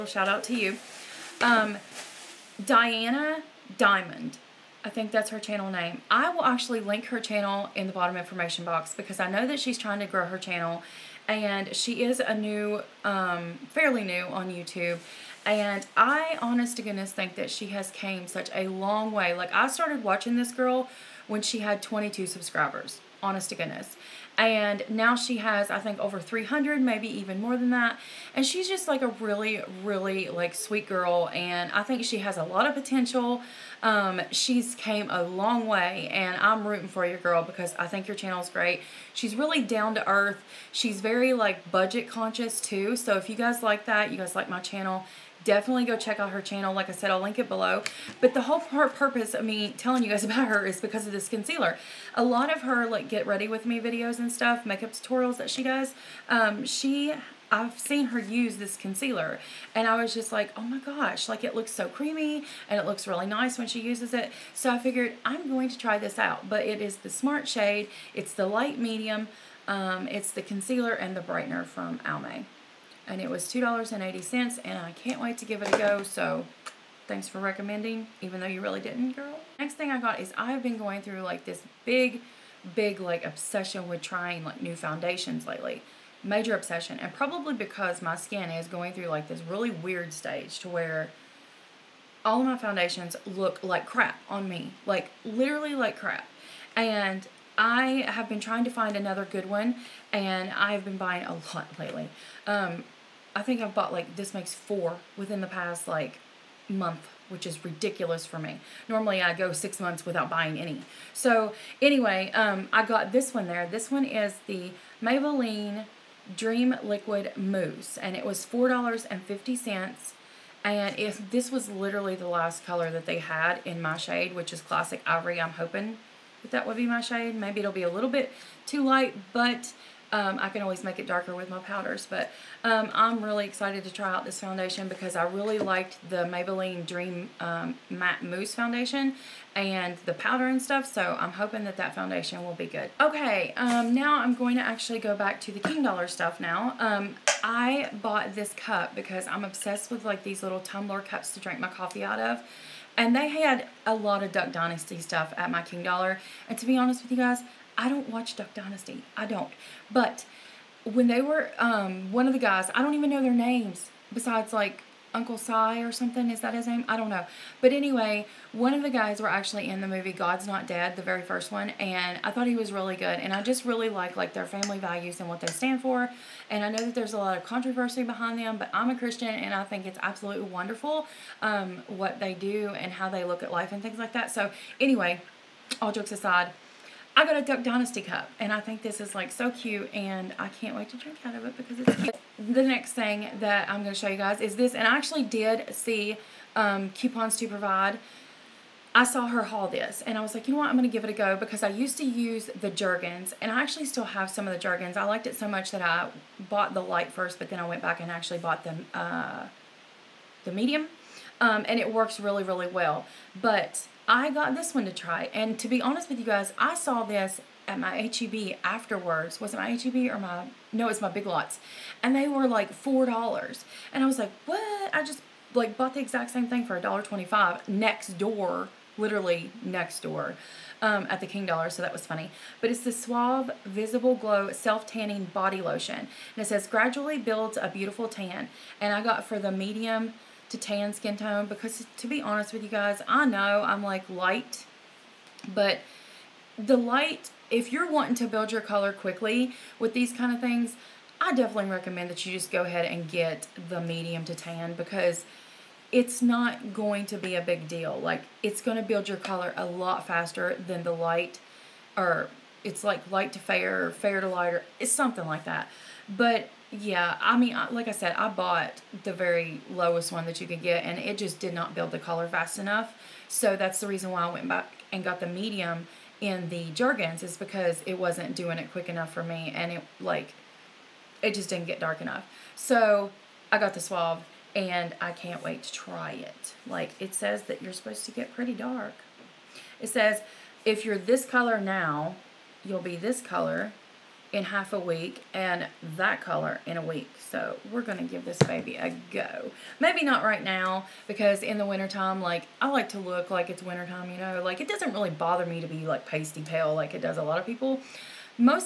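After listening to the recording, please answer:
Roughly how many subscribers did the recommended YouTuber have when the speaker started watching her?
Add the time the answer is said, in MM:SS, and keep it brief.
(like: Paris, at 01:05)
22, at 00:21.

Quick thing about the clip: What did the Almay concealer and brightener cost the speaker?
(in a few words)
$2.80.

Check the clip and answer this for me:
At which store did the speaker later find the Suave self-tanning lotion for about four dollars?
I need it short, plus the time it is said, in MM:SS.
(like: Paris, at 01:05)
Big Lots, at 03:41.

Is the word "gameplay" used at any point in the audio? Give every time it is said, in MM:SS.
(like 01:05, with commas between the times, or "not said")
not said.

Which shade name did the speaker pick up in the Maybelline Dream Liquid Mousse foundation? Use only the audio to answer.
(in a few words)
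Classic Ivory.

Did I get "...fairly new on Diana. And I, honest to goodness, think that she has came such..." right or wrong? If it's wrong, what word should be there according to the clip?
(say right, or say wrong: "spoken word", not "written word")
wrong: "YouTube", not "Diana".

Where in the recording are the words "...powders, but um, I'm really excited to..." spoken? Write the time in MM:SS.
02:11.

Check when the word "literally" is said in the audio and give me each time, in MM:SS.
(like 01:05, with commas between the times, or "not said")
01:35, 02:01, 03:48.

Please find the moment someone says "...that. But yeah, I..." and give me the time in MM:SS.
04:25.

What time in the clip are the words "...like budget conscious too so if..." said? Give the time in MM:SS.
00:41.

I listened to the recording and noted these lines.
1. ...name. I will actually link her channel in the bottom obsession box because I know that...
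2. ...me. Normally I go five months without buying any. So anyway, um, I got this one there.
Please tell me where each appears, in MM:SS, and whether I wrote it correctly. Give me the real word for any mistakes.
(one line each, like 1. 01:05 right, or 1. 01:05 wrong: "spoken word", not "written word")
1. 00:05 wrong: "information", not "obsession"
2. 01:48 wrong: "six", not "five".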